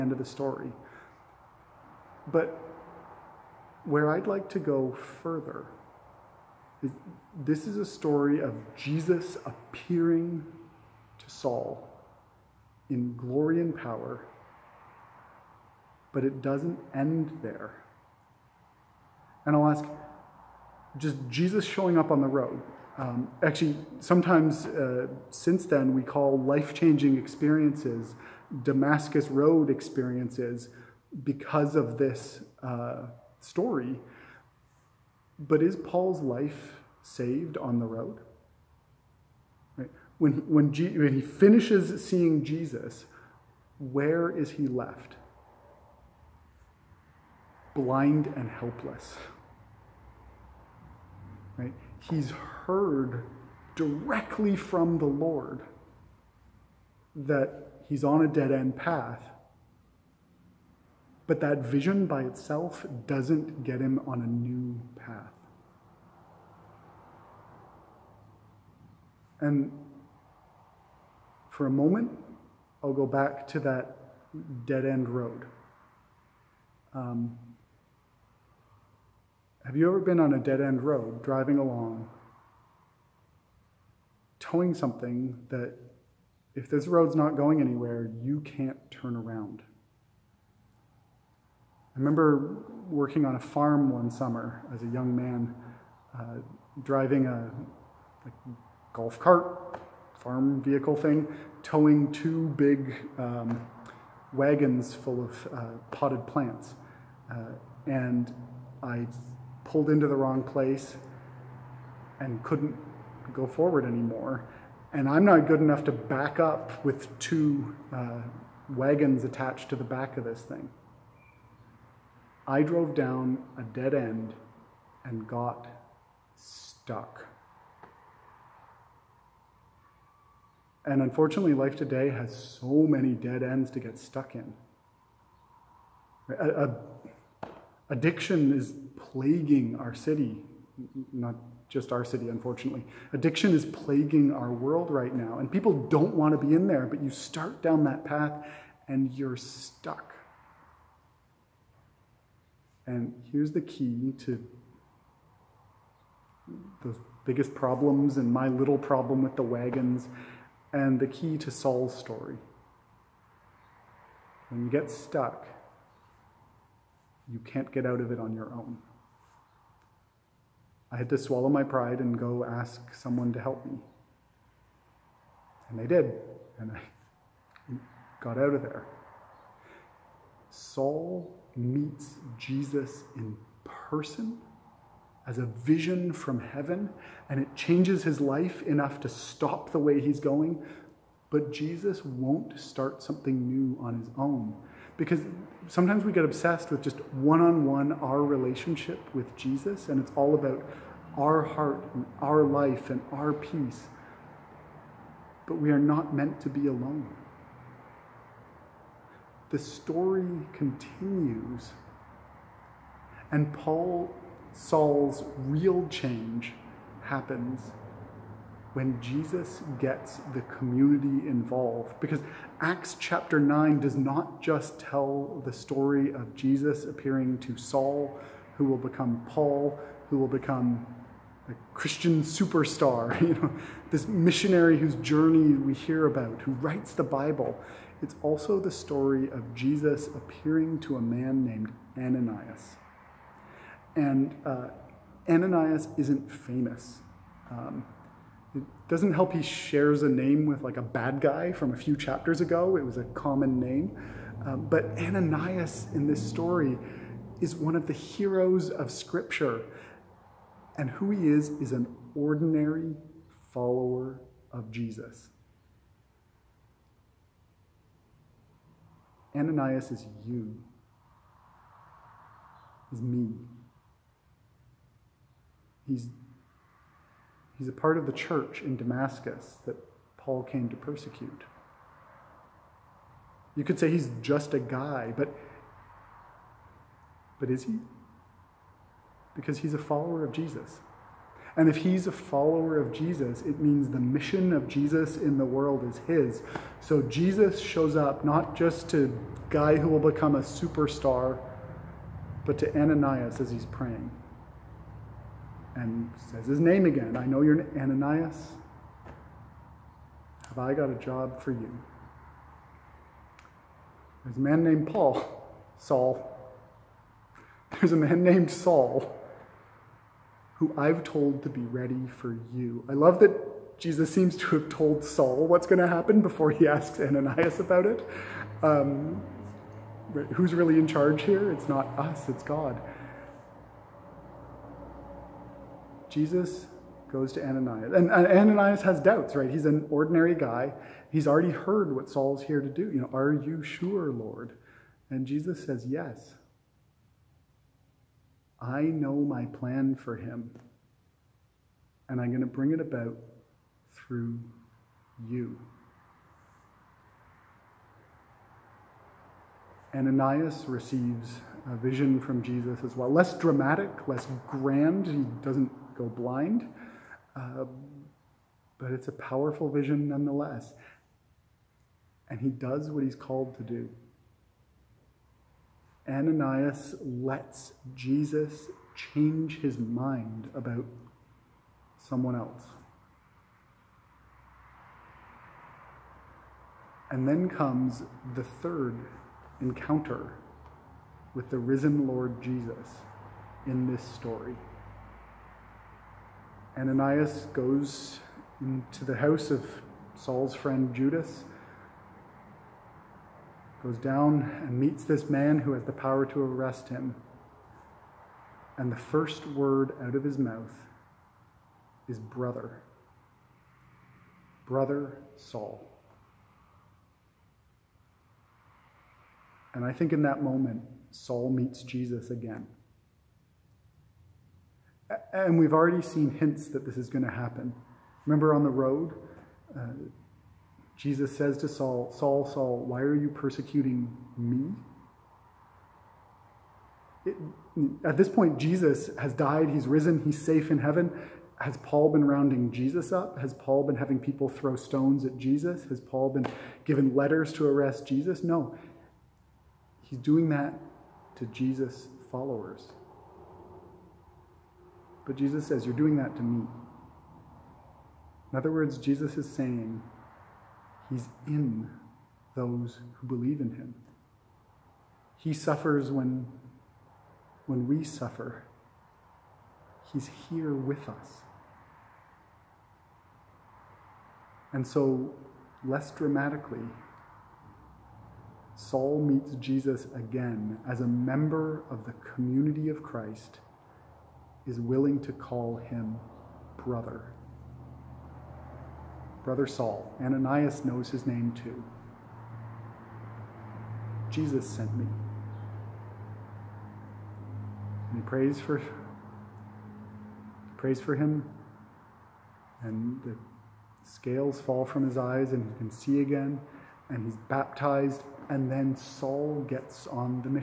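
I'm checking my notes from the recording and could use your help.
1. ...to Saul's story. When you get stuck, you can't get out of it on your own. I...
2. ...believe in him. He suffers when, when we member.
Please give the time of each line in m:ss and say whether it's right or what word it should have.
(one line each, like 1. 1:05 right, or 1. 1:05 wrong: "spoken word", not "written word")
1. 2:41 right
2. 7:43 wrong: "suffer", not "member".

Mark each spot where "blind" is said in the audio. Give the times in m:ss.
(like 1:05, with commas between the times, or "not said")
0:47, 6:06.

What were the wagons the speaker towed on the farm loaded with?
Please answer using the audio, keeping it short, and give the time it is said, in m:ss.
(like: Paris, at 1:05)
Potted plants, at 1:45.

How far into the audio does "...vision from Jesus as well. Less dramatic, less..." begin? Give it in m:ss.
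6:01.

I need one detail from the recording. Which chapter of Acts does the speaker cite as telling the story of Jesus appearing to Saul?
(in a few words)
Chapter 9.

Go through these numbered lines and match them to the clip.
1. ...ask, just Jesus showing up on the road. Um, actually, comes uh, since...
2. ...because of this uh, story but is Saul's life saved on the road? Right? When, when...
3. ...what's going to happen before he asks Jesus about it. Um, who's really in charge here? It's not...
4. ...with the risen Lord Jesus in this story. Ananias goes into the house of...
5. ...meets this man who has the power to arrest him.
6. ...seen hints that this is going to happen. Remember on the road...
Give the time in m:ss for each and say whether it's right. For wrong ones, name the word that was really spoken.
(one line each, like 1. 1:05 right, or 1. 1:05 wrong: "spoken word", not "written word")
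1. 0:19 wrong: "sometimes", not "comes"
2. 0:31 wrong: "Paul", not "Saul"
3. 5:25 wrong: "Ananias", not "Jesus"
4. 6:31 right
5. 6:44 right
6. 7:06 right.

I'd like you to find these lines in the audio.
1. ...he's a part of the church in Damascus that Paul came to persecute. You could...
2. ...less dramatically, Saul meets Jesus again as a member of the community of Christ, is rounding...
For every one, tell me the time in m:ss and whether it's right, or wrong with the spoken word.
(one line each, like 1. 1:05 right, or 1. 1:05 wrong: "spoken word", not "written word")
1. 4:37 right
2. 7:55 wrong: "willing", not "rounding".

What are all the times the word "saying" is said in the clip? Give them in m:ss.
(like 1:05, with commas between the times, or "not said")
7:39.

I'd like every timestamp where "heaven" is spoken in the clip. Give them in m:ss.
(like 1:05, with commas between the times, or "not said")
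3:06, 7:20.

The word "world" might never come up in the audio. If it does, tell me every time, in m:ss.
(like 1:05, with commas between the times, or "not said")
2:24, 4:55.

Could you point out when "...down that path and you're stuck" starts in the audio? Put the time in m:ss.
2:27.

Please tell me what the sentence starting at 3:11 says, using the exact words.
But Jesus won't start something new on his own.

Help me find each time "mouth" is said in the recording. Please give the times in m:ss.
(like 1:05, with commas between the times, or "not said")
6:50.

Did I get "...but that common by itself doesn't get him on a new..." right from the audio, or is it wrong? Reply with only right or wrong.
wrong.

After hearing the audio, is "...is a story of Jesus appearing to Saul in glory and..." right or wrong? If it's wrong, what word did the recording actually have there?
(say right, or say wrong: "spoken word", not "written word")
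right.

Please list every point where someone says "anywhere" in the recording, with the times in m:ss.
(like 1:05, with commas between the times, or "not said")
1:27.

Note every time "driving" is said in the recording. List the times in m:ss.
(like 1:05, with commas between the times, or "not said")
1:21, 1:36.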